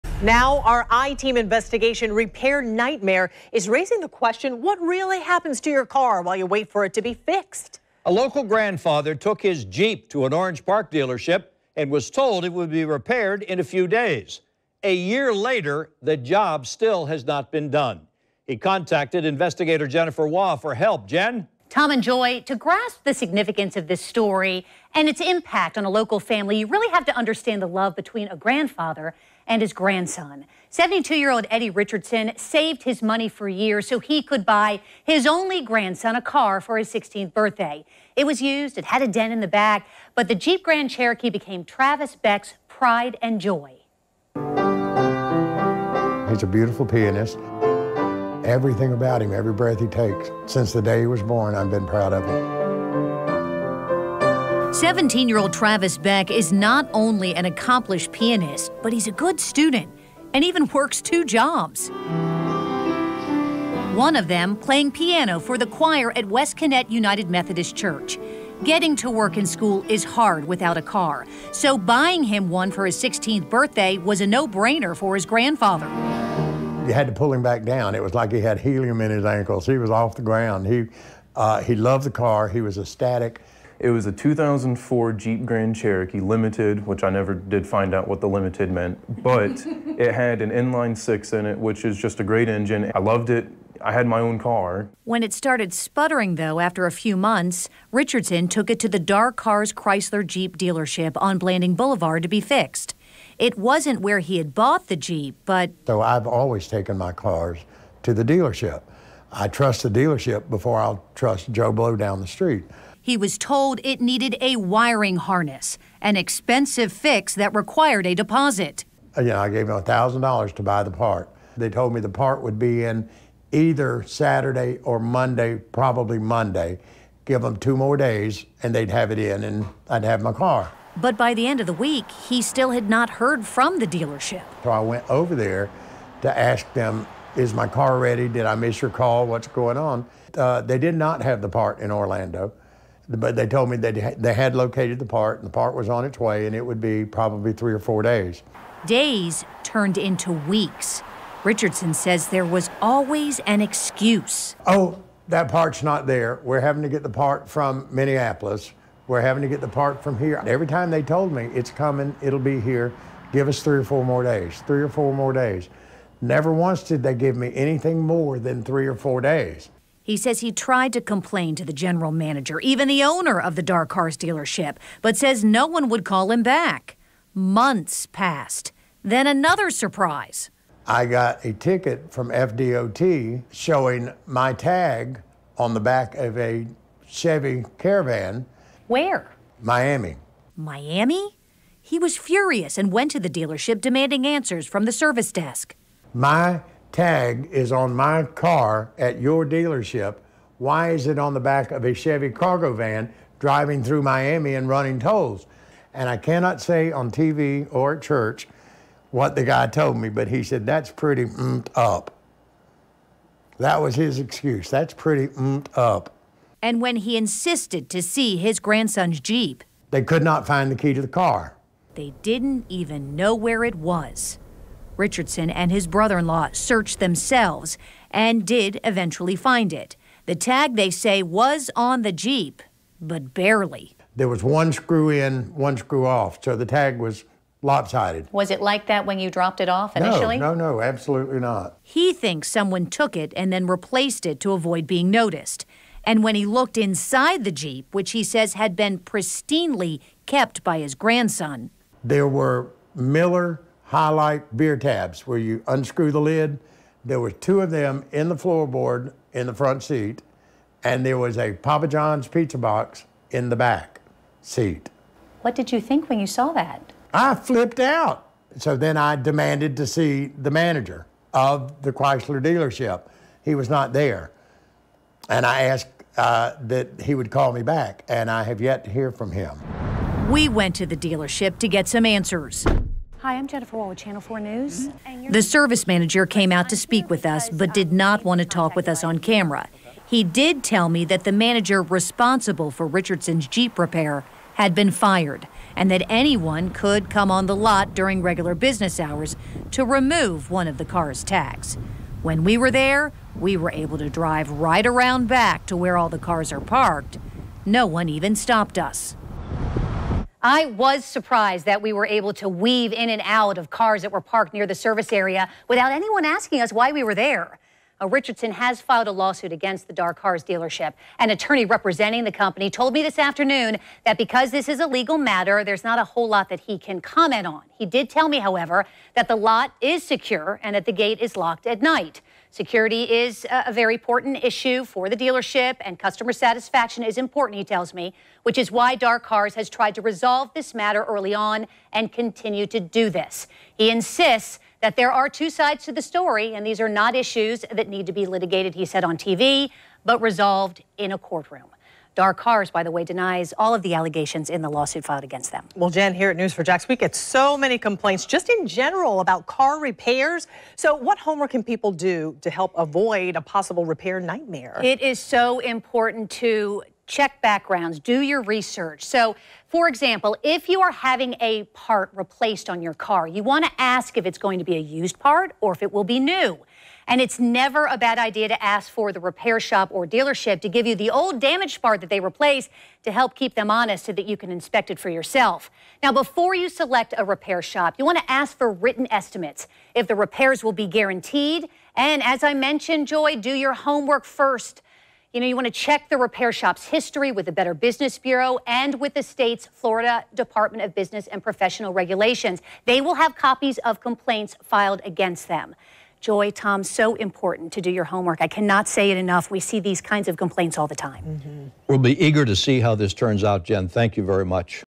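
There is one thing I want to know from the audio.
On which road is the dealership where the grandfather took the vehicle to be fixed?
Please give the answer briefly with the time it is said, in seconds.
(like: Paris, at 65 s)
Blanding Boulevard, at 101 s.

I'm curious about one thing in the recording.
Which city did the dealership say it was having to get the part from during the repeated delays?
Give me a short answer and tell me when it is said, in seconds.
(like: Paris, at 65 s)
Minneapolis, at 157 s.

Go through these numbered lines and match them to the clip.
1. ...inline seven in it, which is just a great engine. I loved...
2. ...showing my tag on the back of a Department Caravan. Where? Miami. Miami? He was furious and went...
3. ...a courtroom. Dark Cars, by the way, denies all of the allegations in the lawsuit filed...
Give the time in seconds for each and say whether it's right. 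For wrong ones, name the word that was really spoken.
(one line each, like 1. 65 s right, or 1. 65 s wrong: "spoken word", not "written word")
1. 90 s wrong: "six", not "seven"
2. 183 s wrong: "Chevy", not "Department"
3. 351 s right.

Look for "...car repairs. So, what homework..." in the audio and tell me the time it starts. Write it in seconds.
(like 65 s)
359 s.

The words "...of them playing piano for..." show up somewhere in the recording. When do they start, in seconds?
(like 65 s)
64 s.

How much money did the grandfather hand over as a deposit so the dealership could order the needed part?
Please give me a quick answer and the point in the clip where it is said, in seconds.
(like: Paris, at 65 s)
$1,000, at 119 s.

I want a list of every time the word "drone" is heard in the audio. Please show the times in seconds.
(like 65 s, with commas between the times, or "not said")
not said.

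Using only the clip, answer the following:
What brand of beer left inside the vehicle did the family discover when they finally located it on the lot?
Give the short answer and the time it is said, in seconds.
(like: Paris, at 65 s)
Miller High Life, at 252 s.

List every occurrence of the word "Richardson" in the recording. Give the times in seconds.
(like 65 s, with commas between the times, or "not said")
31 s, 97 s, 151 s, 225 s, 292 s, 318 s.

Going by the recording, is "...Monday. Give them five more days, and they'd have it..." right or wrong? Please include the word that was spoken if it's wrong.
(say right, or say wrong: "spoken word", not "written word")
wrong: "two", not "five".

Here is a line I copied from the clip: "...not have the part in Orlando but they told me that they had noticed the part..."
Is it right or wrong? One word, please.
wrong.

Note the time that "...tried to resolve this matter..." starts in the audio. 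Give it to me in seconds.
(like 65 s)
339 s.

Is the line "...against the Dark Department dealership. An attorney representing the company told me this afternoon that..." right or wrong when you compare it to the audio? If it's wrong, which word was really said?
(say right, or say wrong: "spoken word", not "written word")
wrong: "Cars", not "Department".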